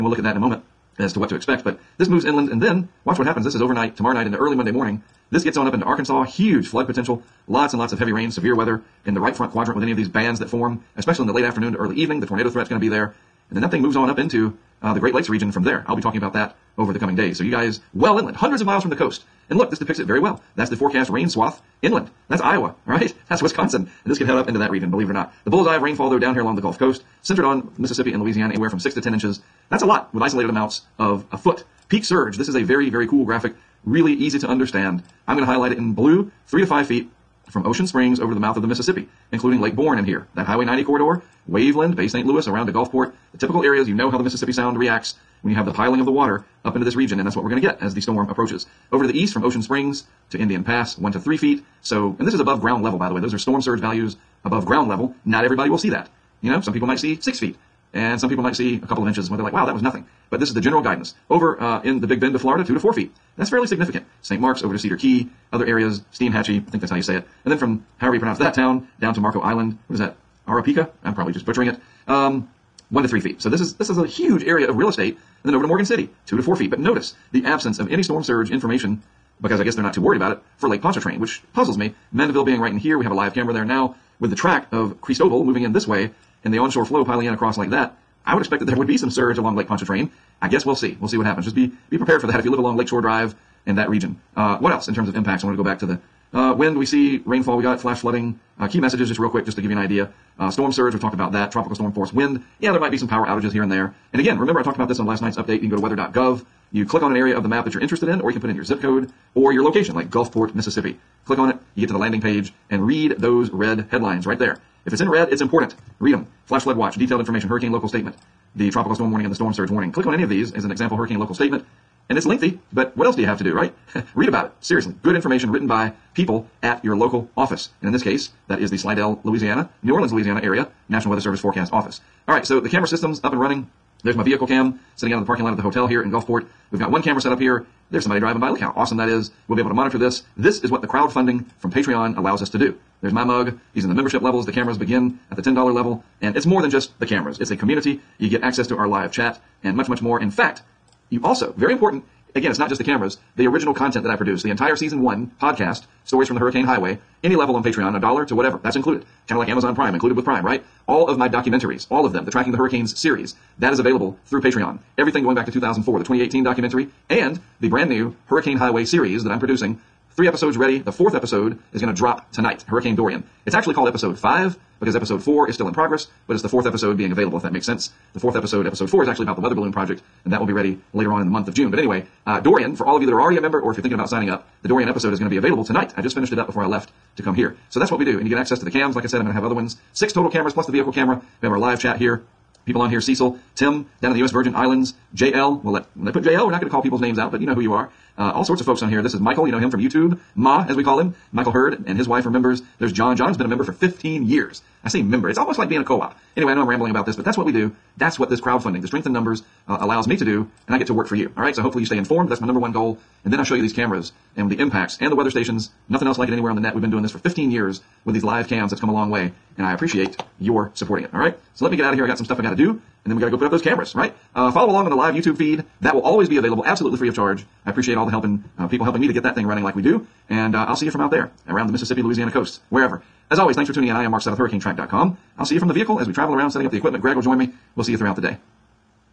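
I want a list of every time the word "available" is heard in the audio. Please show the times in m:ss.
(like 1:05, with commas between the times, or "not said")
2:43, 2:57, 3:05, 3:46.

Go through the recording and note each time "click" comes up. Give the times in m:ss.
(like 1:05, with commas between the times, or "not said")
1:46, 1:51, 1:59.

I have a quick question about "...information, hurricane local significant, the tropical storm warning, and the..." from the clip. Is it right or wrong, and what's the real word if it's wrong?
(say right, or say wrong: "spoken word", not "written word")
wrong: "statement", not "significant".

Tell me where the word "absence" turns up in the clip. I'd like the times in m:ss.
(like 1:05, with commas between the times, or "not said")
1:17.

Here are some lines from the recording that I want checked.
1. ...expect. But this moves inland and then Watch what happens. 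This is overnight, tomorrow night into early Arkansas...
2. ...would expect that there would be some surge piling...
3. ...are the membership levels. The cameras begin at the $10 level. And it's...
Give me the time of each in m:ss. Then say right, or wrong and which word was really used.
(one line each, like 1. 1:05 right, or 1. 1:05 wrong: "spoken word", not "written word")
1. 0:01 wrong: "Monday", not "Arkansas"
2. 1:28 wrong: "along", not "piling"
3. 2:23 right.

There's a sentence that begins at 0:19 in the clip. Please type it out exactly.
And look, this depicts it very well.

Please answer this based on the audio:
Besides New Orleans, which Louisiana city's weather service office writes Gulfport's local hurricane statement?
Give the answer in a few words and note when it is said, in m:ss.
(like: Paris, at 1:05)
Slidell, at 2:08.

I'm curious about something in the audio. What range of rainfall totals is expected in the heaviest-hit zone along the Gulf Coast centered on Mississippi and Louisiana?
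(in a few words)
6 to 10 inches.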